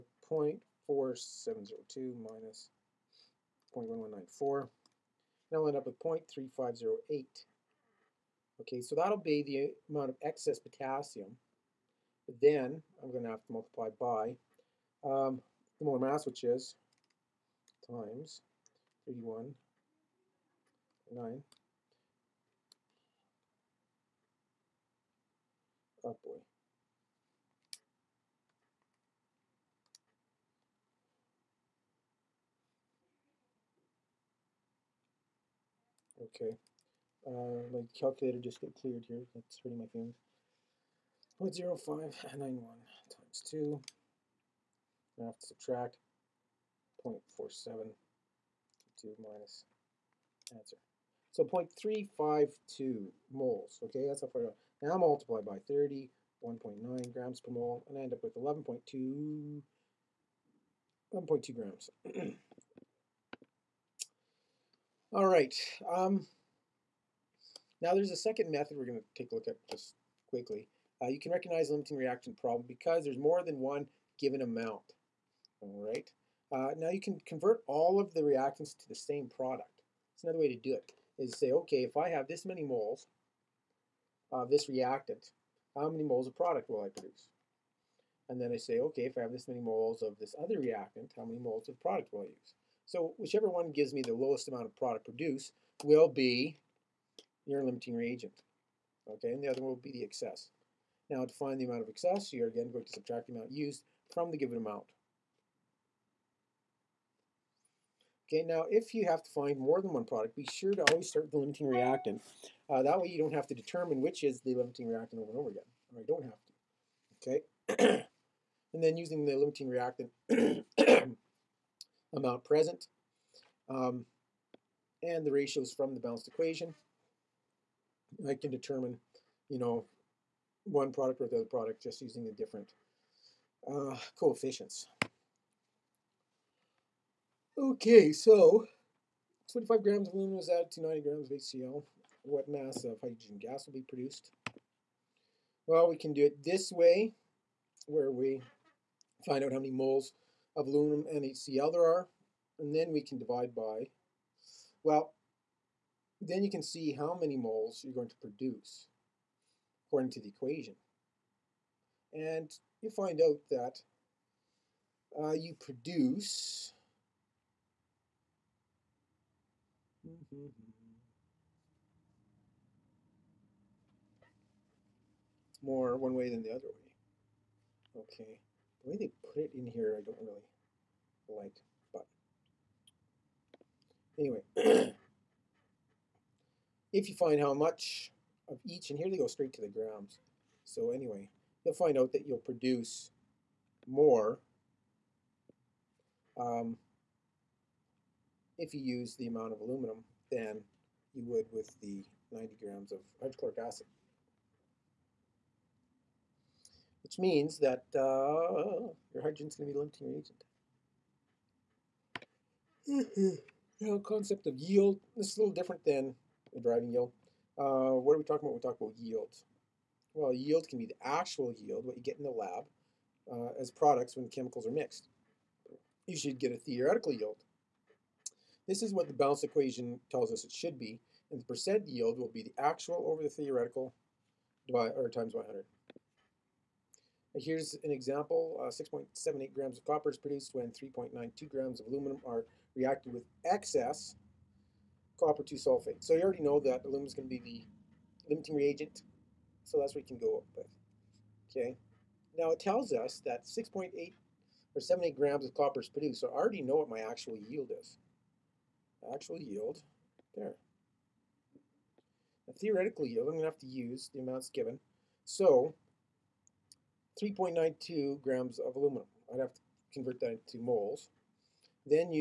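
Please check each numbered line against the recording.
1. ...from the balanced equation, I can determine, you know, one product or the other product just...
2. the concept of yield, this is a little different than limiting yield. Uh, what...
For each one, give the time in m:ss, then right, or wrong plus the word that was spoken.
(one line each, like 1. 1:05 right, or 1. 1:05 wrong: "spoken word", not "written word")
1. 2:05 right
2. 3:33 wrong: "driving", not "limiting".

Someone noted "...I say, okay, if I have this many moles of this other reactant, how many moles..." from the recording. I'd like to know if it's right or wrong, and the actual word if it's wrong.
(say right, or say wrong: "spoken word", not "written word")
right.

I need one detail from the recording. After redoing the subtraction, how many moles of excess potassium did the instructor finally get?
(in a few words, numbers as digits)
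0.352 moles.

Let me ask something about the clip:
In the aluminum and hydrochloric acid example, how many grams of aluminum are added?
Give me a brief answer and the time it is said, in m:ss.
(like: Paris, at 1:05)
25 grams, at 2:19.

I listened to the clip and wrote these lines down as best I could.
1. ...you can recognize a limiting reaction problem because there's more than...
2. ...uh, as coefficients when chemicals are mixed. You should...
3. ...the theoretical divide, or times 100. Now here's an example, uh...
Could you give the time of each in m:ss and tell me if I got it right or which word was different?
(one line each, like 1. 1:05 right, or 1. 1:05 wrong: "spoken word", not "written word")
1. 1:11 right
2. 3:43 wrong: "products", not "coefficients"
3. 3:53 right.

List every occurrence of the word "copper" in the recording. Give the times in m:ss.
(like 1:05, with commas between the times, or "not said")
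3:59, 4:05, 4:15.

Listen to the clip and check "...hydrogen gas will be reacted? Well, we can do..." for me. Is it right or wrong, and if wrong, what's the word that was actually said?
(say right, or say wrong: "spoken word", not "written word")
wrong: "produced", not "reacted".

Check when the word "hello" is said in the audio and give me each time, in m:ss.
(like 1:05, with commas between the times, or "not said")
not said.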